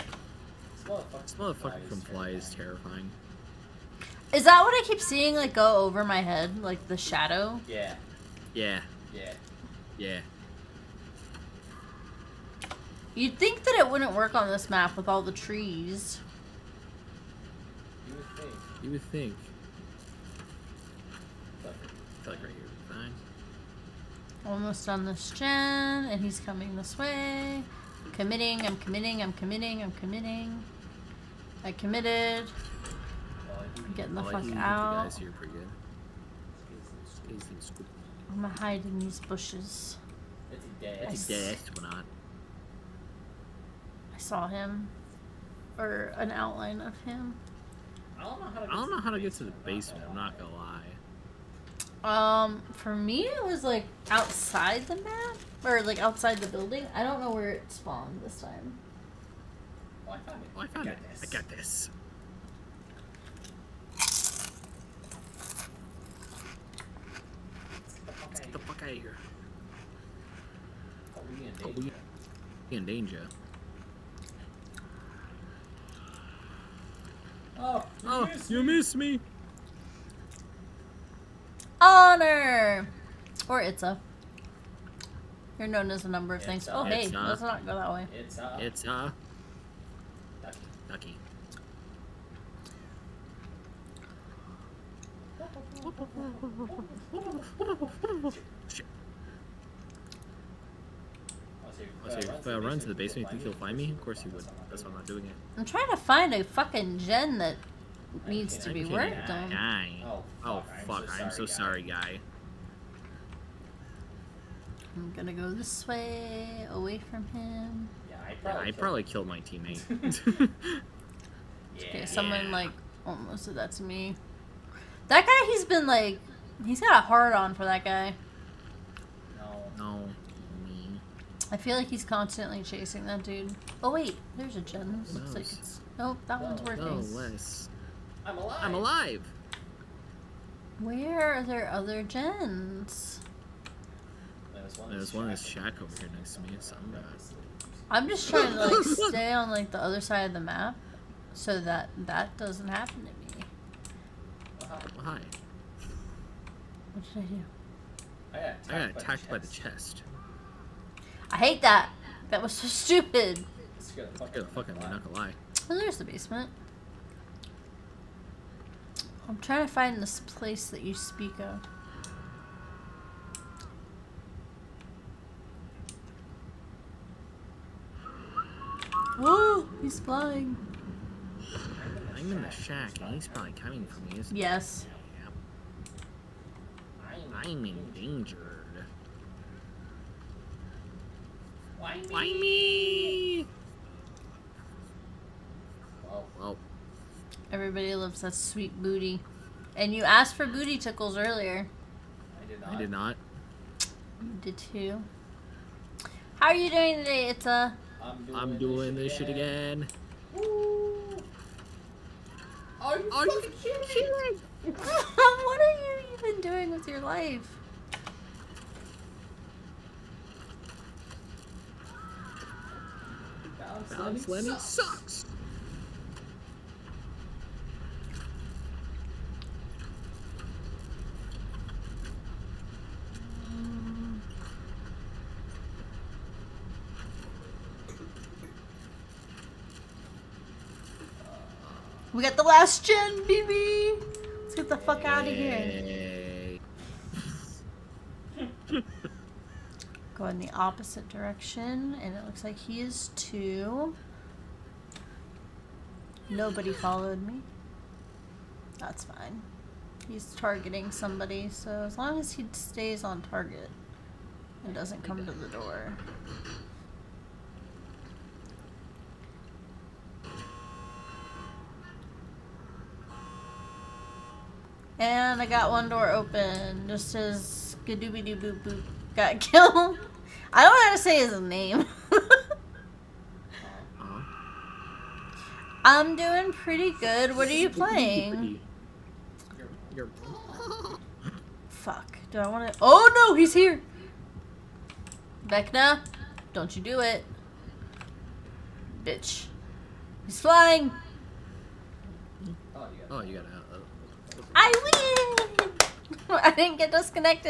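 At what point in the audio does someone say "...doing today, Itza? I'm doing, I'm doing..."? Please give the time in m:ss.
3:26.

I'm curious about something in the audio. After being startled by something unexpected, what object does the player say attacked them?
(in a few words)
the chest.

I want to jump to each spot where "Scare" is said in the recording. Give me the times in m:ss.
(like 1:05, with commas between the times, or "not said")
2:43.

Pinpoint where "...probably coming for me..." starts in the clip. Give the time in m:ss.
3:03.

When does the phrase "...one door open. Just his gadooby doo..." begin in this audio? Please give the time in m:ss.
4:35.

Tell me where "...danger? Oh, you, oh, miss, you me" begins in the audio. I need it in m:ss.
1:12.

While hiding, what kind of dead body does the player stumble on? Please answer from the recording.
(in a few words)
dead astronaut.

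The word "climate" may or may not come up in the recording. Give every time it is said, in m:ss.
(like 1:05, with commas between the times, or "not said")
not said.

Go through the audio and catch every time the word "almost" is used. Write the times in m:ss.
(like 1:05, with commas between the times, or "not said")
0:24, 2:03.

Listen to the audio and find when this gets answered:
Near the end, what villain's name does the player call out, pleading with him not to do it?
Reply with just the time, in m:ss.
4:55.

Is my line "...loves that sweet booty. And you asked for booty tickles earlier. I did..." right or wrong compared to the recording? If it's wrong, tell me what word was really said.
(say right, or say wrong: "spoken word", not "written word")
right.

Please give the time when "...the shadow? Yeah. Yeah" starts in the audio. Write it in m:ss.
0:06.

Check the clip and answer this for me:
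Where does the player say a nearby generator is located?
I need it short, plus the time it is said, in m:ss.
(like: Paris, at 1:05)
in shack, at 2:25.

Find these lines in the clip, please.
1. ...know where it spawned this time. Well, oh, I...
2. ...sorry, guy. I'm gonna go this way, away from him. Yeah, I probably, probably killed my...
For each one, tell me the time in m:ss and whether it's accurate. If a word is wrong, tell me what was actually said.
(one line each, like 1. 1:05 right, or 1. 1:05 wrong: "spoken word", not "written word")
1. 0:57 right
2. 1:51 right.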